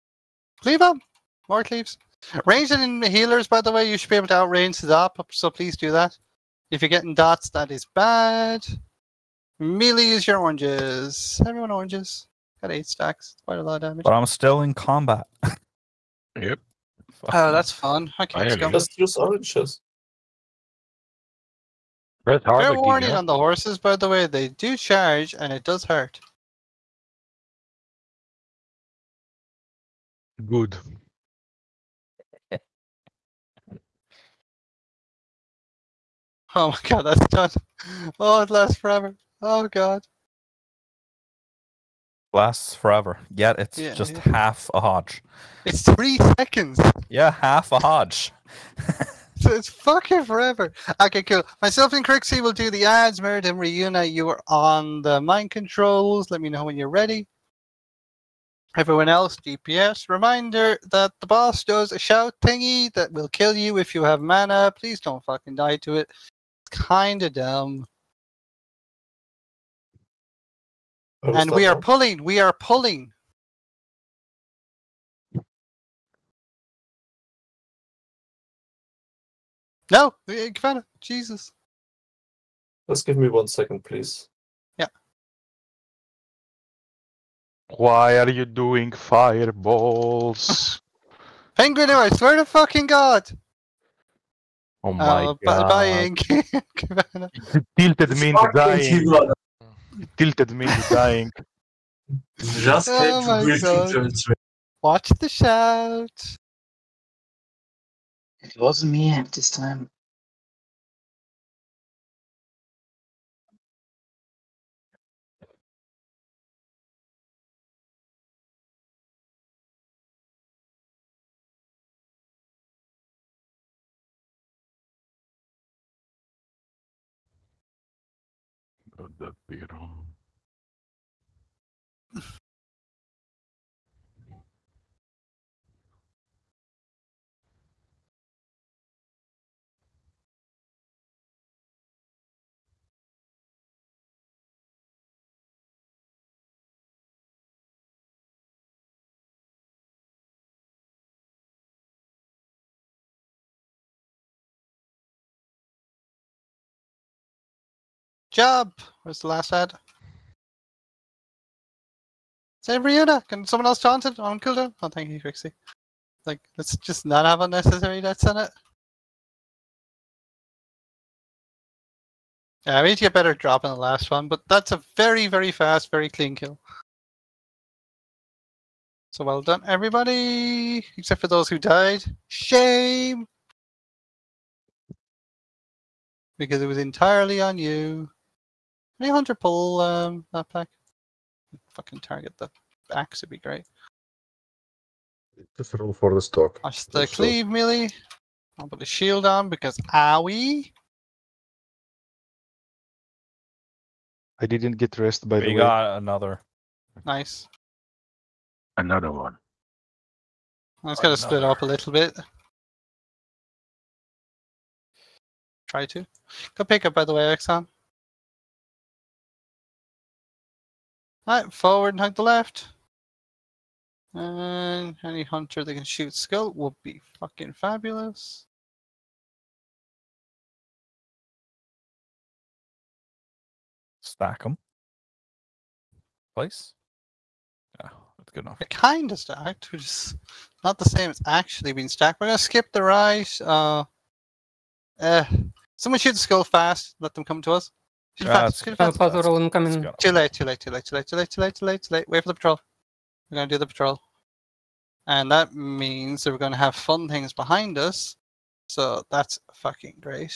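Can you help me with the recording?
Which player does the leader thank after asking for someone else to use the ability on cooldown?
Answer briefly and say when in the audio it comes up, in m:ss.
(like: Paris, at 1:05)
Trixie, at 2:45.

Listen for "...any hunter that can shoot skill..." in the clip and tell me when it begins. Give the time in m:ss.
3:45.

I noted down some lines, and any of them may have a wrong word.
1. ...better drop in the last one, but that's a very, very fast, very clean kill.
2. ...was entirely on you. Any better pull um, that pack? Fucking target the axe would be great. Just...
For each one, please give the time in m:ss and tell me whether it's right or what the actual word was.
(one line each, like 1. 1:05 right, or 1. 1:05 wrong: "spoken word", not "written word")
1. 2:53 right
2. 3:06 wrong: "hunter", not "better".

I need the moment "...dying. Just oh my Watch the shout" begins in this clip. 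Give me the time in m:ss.
1:40.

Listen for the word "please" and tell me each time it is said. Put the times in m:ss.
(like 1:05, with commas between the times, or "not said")
0:05, 1:04, 1:23.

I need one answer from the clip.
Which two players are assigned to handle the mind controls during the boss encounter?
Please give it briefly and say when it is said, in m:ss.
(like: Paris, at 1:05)
Meredith and Reuna, at 0:53.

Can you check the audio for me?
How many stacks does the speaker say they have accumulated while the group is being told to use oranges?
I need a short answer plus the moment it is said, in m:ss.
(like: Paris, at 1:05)
8, at 0:12.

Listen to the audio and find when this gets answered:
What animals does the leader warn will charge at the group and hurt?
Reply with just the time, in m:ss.
0:23.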